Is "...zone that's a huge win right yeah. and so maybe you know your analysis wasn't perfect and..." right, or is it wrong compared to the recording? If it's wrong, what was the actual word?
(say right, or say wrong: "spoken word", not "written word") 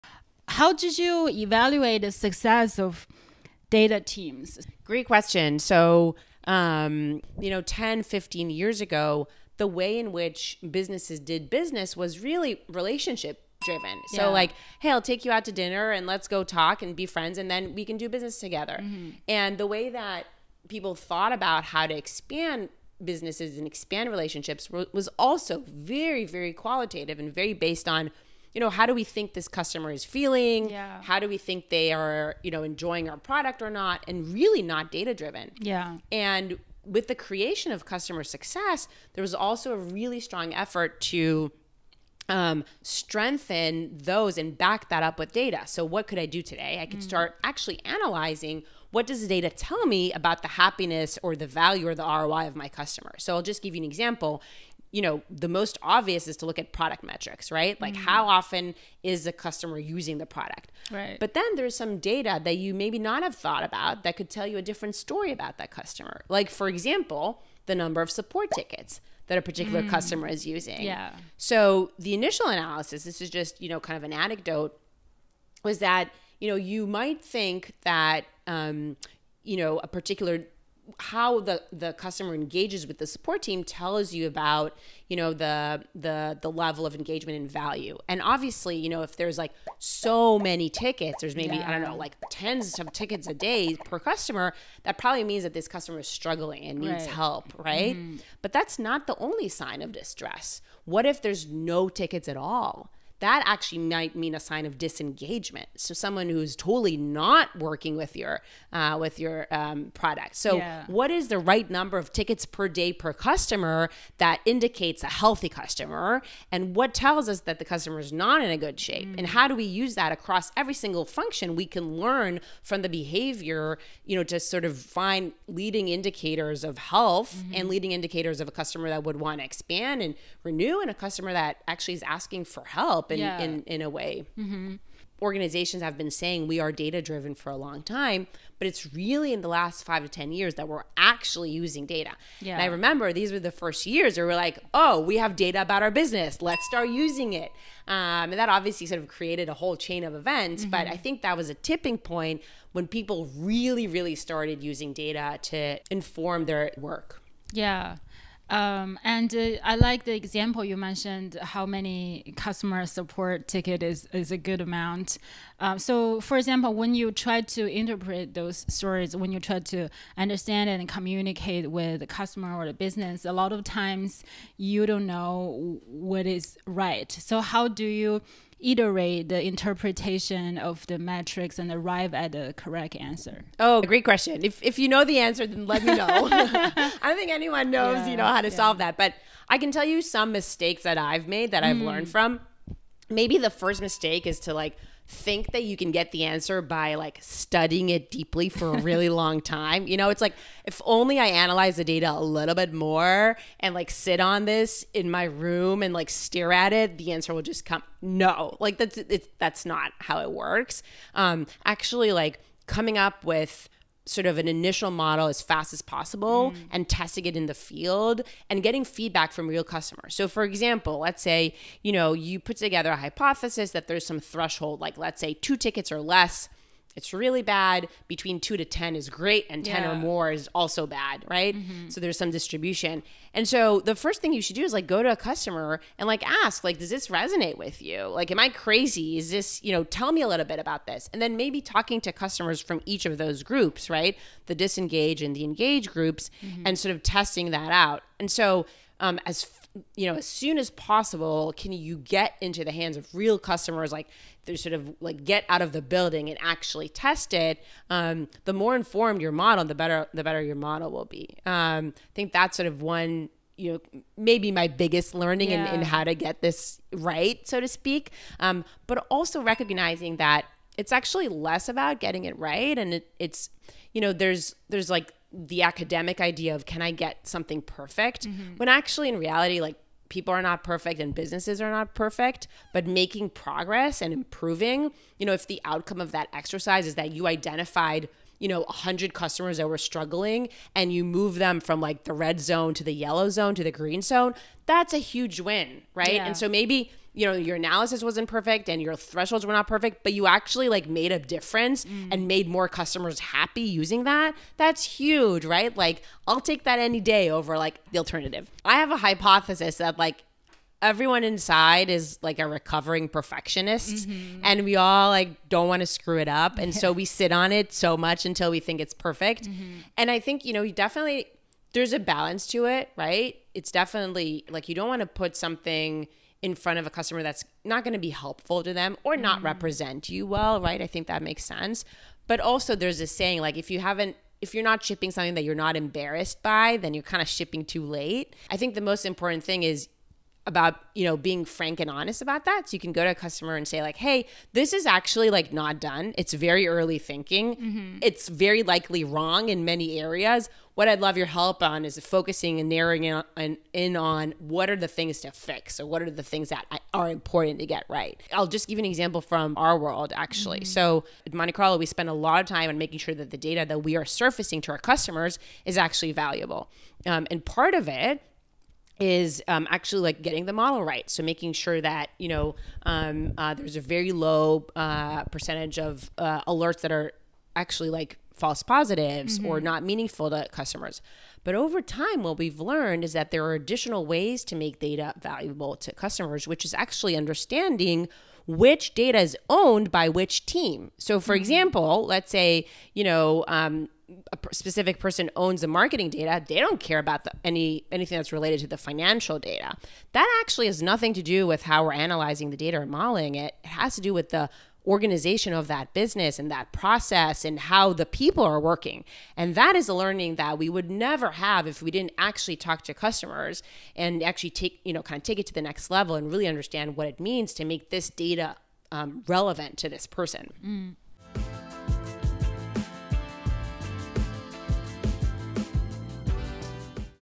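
right.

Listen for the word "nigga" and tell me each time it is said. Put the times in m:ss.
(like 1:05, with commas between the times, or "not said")
not said.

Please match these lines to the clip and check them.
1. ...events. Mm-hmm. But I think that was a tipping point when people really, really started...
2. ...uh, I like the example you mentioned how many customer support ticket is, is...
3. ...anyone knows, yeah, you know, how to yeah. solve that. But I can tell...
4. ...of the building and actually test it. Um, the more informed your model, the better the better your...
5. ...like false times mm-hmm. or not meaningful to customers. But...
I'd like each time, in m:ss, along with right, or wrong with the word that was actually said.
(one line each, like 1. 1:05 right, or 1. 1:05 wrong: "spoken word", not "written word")
1. 2:30 right
2. 2:39 right
3. 3:07 right
4. 4:15 right
5. 6:17 wrong: "positives", not "times".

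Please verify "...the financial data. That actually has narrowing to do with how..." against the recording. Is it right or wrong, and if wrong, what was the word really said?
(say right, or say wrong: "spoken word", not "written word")
wrong: "nothing", not "narrowing".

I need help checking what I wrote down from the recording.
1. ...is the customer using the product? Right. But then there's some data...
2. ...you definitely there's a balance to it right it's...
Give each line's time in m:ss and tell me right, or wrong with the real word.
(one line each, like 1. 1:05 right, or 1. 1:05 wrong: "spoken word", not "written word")
1. 0:59 right
2. 5:20 right.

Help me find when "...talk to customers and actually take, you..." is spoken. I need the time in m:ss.
6:52.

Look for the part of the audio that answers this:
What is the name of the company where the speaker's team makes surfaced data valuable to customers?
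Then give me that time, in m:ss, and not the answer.
6:01.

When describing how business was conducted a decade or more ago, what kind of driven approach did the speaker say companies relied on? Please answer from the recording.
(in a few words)
relationship driven.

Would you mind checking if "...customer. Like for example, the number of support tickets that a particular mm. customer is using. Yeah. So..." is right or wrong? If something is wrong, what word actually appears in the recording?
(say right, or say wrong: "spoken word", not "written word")
right.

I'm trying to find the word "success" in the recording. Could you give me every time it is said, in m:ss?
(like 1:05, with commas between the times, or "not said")
0:02, 0:38.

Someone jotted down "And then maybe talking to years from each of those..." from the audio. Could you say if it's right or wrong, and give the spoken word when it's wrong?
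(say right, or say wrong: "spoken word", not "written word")
wrong: "customers", not "years".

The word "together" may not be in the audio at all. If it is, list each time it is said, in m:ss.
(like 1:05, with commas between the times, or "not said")
0:18, 3:42.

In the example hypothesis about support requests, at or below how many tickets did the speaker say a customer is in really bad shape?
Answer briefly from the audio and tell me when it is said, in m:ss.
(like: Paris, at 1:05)
2, at 3:45.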